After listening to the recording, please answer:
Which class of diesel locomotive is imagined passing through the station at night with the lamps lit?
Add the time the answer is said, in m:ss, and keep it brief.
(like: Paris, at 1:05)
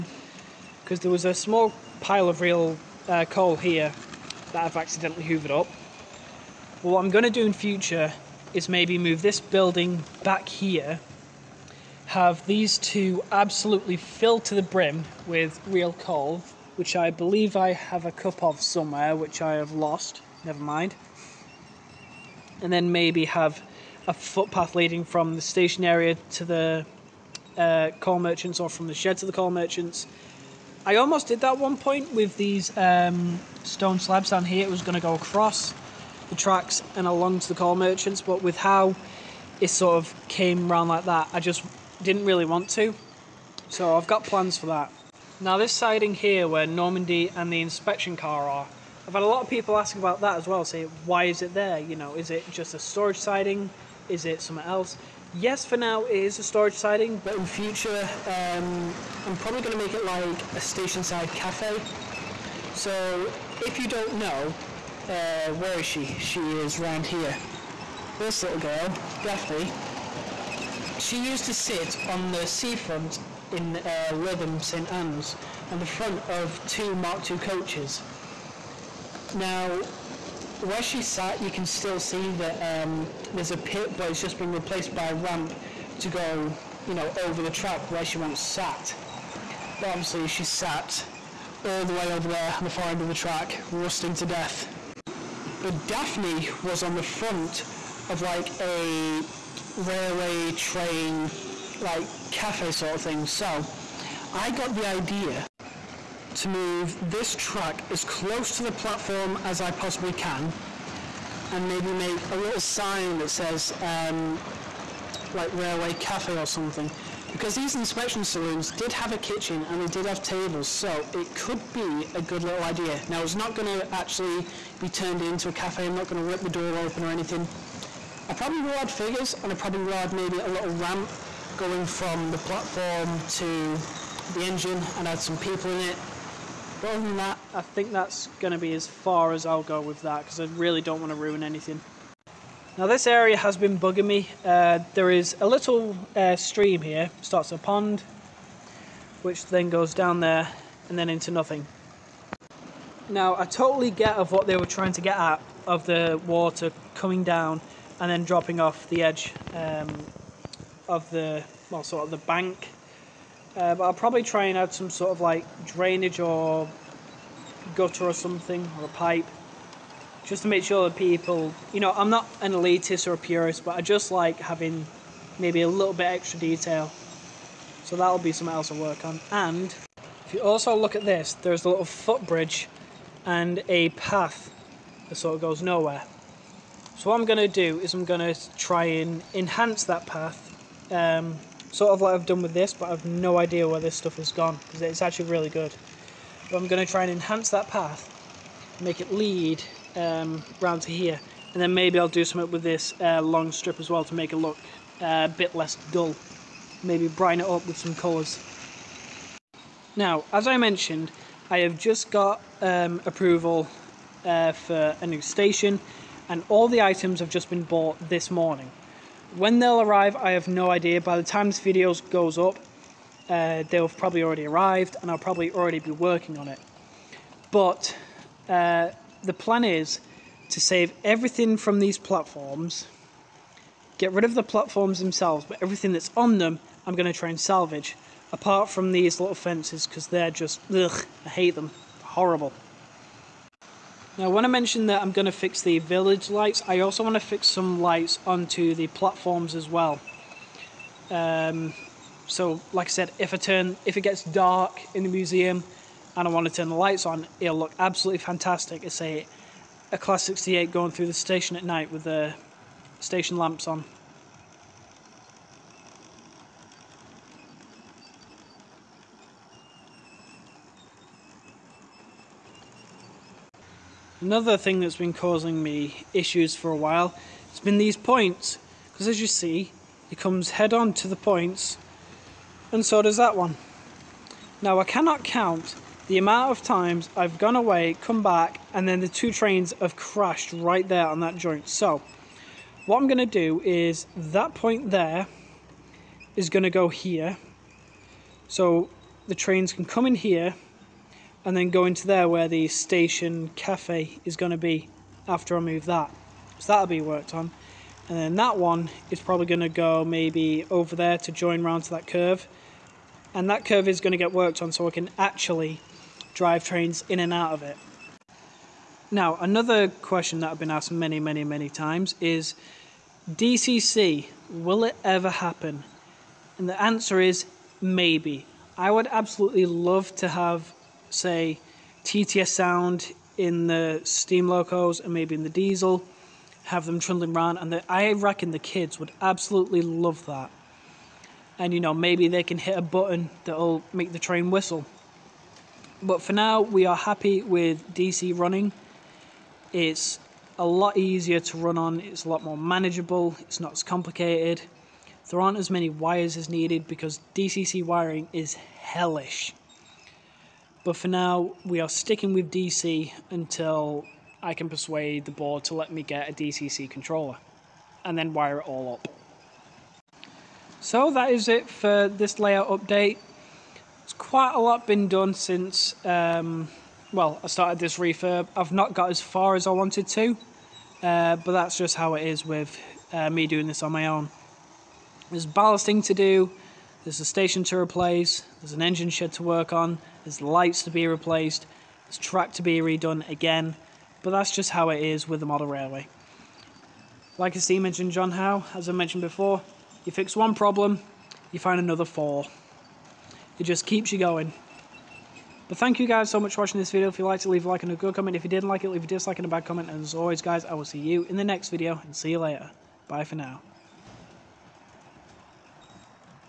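Class 68, at 4:19.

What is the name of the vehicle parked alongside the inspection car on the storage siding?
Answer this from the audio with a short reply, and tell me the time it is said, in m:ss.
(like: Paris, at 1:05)
Normandy, at 0:46.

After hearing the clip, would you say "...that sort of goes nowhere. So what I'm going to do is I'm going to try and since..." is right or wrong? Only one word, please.
wrong.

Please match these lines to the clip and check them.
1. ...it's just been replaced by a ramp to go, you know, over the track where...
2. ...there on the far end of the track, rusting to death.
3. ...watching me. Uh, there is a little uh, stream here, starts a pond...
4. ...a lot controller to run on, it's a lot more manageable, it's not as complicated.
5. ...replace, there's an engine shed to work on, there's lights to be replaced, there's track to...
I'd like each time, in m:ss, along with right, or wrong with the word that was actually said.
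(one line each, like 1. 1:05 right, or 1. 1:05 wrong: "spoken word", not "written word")
1. 1:24 right
2. 1:32 right
3. 2:23 wrong: "bugging", not "watching"
4. 5:50 wrong: "easier", not "controller"
5. 6:27 right.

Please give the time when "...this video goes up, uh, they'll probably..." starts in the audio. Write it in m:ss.
3:41.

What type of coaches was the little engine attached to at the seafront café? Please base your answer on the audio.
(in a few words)
Mark II.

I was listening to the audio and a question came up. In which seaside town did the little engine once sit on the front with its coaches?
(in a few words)
Lytham St Anne's.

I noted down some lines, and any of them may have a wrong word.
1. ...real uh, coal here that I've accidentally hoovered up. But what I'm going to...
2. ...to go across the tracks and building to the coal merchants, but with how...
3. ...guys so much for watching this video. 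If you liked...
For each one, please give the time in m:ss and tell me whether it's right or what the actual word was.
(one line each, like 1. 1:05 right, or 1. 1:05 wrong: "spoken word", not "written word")
1. 0:02 right
2. 0:34 wrong: "along", not "building"
3. 6:46 right.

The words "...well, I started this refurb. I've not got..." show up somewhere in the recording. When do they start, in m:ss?
6:17.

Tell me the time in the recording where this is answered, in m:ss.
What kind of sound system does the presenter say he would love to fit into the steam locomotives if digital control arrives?
5:32.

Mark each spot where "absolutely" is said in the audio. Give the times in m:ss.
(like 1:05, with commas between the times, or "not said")
0:13, 4:17, 5:29, 5:39.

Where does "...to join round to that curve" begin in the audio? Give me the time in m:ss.
5:11.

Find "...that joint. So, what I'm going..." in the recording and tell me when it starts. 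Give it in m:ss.
4:51.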